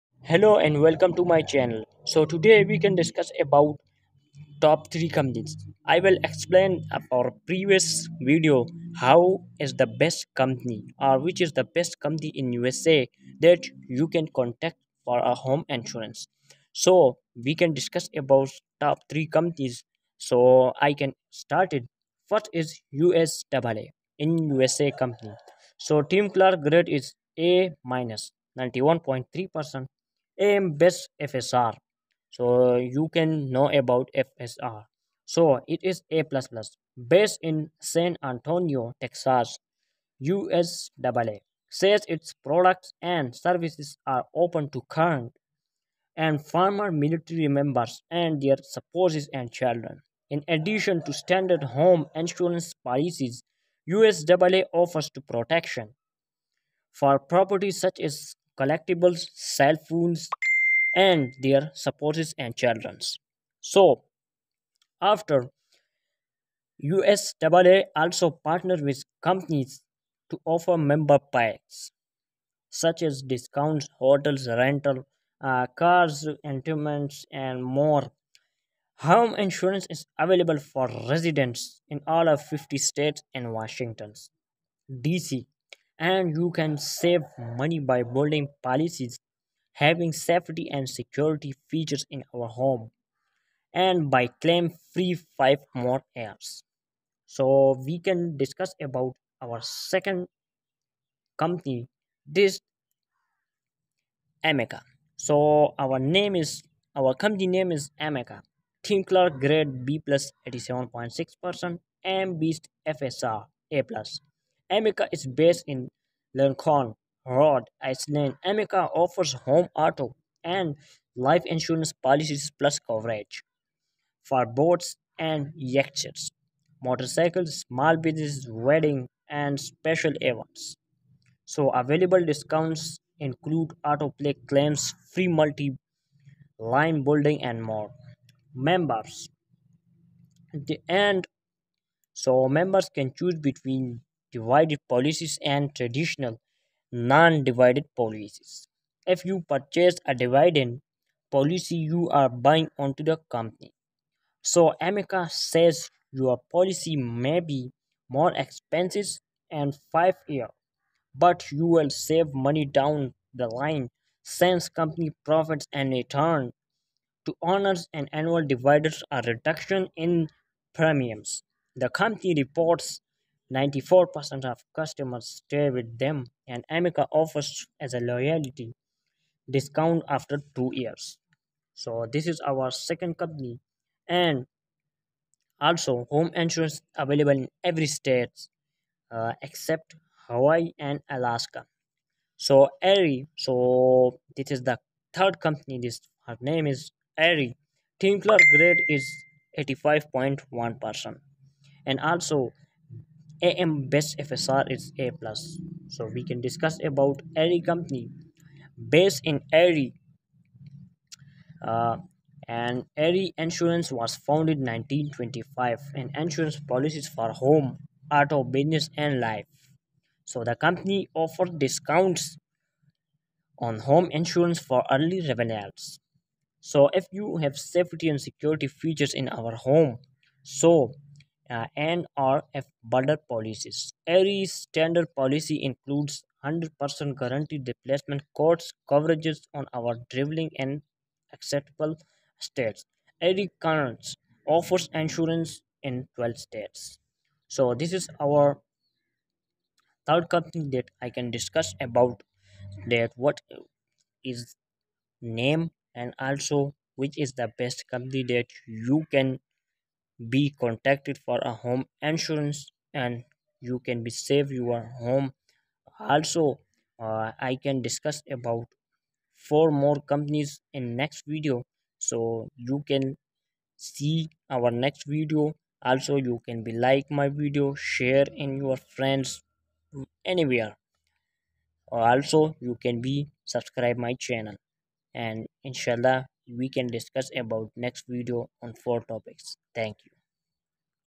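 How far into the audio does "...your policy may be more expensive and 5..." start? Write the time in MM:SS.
02:36.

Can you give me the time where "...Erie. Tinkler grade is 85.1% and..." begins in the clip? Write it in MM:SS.
03:17.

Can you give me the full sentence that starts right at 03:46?
So if you have safety and security features in our home, so uh, NRF border policies.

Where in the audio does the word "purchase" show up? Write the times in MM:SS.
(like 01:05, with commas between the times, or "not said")
02:29.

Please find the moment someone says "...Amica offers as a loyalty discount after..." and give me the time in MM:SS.
02:56.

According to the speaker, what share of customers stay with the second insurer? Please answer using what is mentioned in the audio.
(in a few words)
94%.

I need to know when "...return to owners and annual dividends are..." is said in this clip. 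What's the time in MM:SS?
02:45.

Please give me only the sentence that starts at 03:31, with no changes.
Uh, and Erie Insurance was founded in 1925 and insurance policies for home, auto, business and life.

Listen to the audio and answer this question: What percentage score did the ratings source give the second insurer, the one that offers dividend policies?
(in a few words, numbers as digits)
87.6%.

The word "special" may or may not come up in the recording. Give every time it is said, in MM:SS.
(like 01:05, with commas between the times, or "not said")
02:09.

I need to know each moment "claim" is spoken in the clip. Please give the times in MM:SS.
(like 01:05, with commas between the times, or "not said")
01:34, 02:14.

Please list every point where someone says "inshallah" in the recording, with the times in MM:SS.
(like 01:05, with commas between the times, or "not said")
04:45.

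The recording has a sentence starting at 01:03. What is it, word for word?
So, after USAA also partnered with companies to offer member packs such as discounts, hotels, rental, uh, cars, entertainments, and more.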